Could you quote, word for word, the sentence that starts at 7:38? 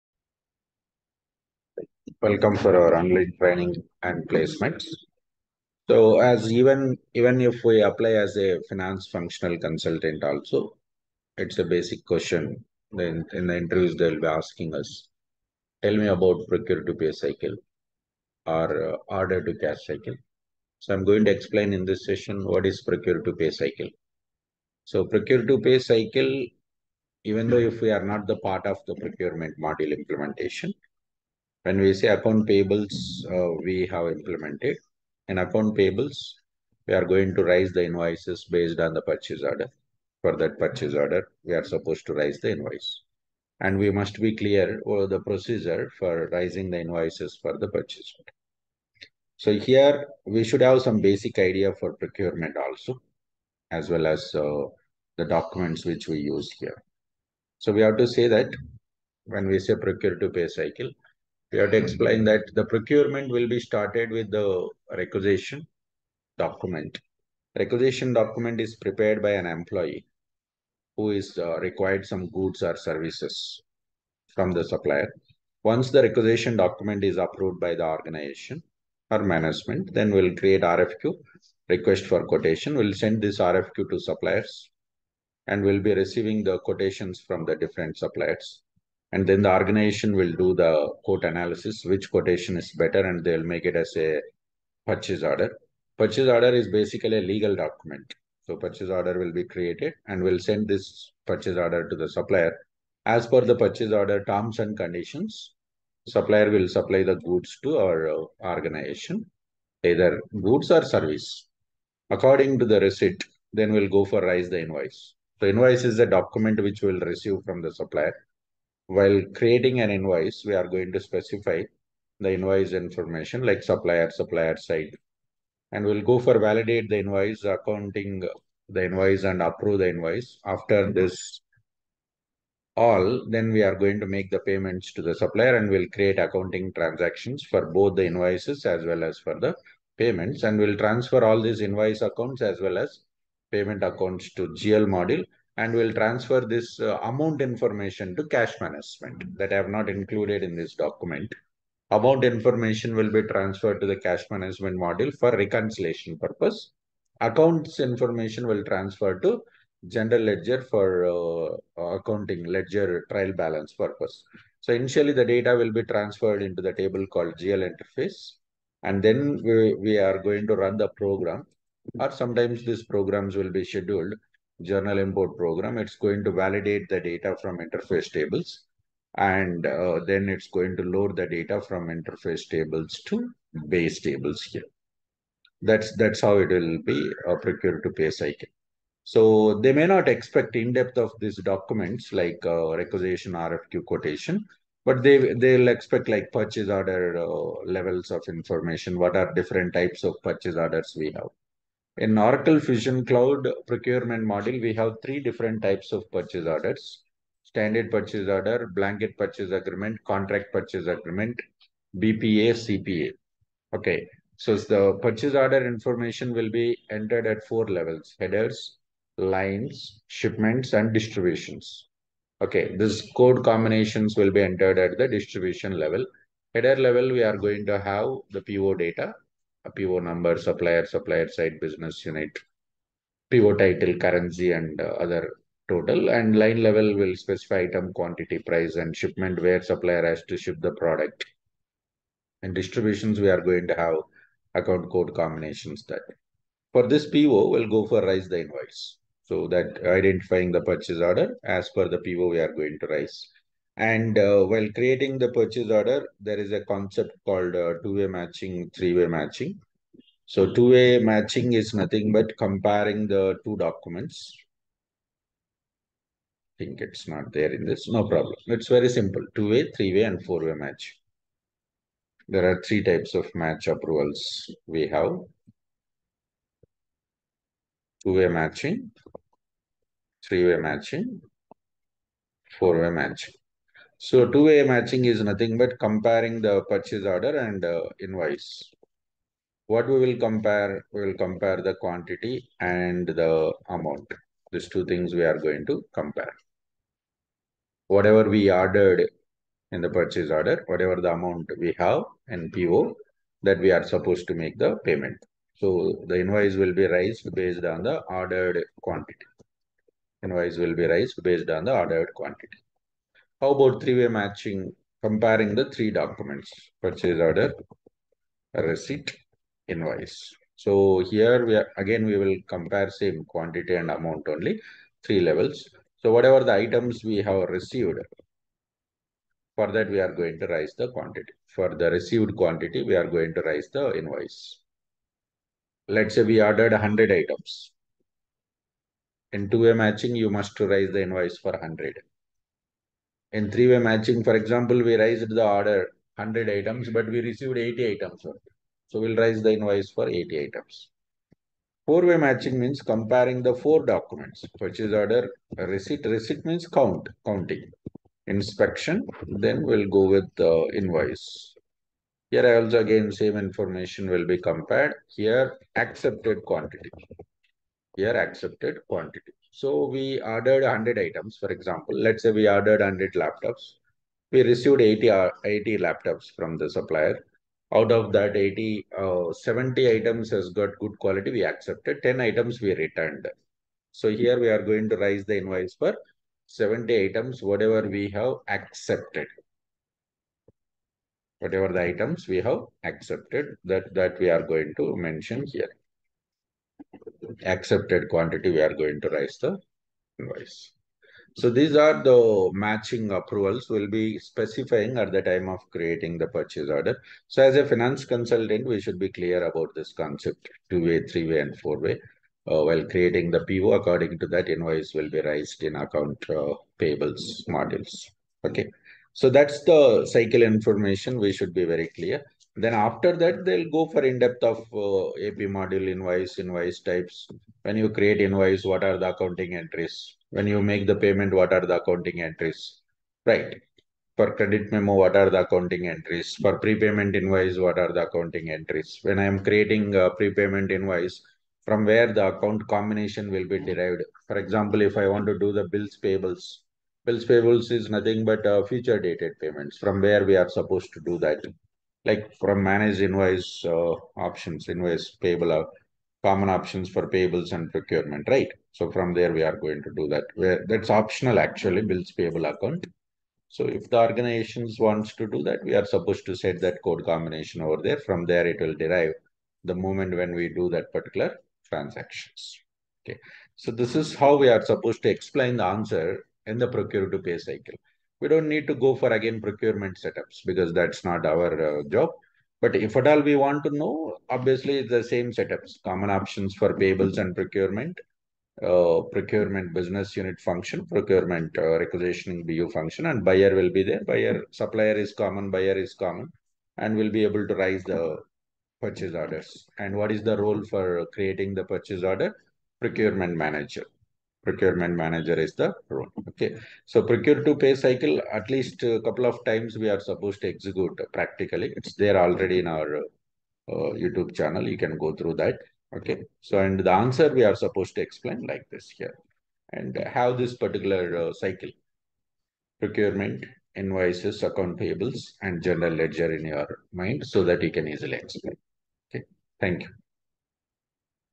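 So from there, we are going to do that.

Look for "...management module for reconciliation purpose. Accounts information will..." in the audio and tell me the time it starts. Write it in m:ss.
2:34.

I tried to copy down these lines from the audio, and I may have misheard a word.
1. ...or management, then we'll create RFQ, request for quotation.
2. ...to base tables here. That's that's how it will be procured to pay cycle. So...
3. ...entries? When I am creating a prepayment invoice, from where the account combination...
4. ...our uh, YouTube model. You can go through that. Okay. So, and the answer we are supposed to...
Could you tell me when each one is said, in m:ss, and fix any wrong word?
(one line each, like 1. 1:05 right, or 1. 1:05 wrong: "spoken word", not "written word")
1. 1:19 right
2. 3:03 right
3. 7:18 right
4. 8:32 wrong: "channel", not "model".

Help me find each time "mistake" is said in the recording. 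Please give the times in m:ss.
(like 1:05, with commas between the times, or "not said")
not said.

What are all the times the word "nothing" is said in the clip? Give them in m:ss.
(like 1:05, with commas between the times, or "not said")
4:21, 4:45, 7:27.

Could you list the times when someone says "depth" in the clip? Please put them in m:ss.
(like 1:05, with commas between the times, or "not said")
3:10, 7:04.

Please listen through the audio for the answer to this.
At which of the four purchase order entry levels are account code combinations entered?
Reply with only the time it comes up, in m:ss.
3:45.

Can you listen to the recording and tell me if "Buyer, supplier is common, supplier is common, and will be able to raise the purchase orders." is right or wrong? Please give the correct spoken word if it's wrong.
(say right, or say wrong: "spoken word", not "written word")
wrong: "buyer", not "supplier".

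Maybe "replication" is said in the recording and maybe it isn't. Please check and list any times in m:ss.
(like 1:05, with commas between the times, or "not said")
not said.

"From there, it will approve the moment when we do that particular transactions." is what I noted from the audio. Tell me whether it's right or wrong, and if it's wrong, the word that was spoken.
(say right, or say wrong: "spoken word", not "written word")
wrong: "derive", not "approve".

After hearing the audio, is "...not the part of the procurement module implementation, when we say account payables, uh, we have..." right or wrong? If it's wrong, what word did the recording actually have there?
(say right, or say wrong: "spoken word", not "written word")
right.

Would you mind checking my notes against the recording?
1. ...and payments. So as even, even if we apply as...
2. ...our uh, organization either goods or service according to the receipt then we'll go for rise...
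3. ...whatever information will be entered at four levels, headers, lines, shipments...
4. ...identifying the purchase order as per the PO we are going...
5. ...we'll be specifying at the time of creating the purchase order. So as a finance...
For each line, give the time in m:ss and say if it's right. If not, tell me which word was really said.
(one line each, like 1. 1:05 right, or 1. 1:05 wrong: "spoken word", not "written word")
1. 0:04 wrong: "placements", not "payments"
2. 1:47 right
3. 3:35 wrong: "order", not "whatever"
4. 4:09 right
5. 6:43 right.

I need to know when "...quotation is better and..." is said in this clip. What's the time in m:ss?
1:32.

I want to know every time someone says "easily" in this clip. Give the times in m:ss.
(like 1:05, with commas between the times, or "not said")
8:47.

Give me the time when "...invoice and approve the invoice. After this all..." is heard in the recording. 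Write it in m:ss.
2:08.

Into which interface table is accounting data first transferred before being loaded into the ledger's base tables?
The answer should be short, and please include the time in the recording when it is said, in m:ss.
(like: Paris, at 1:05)
GL interface, at 2:47.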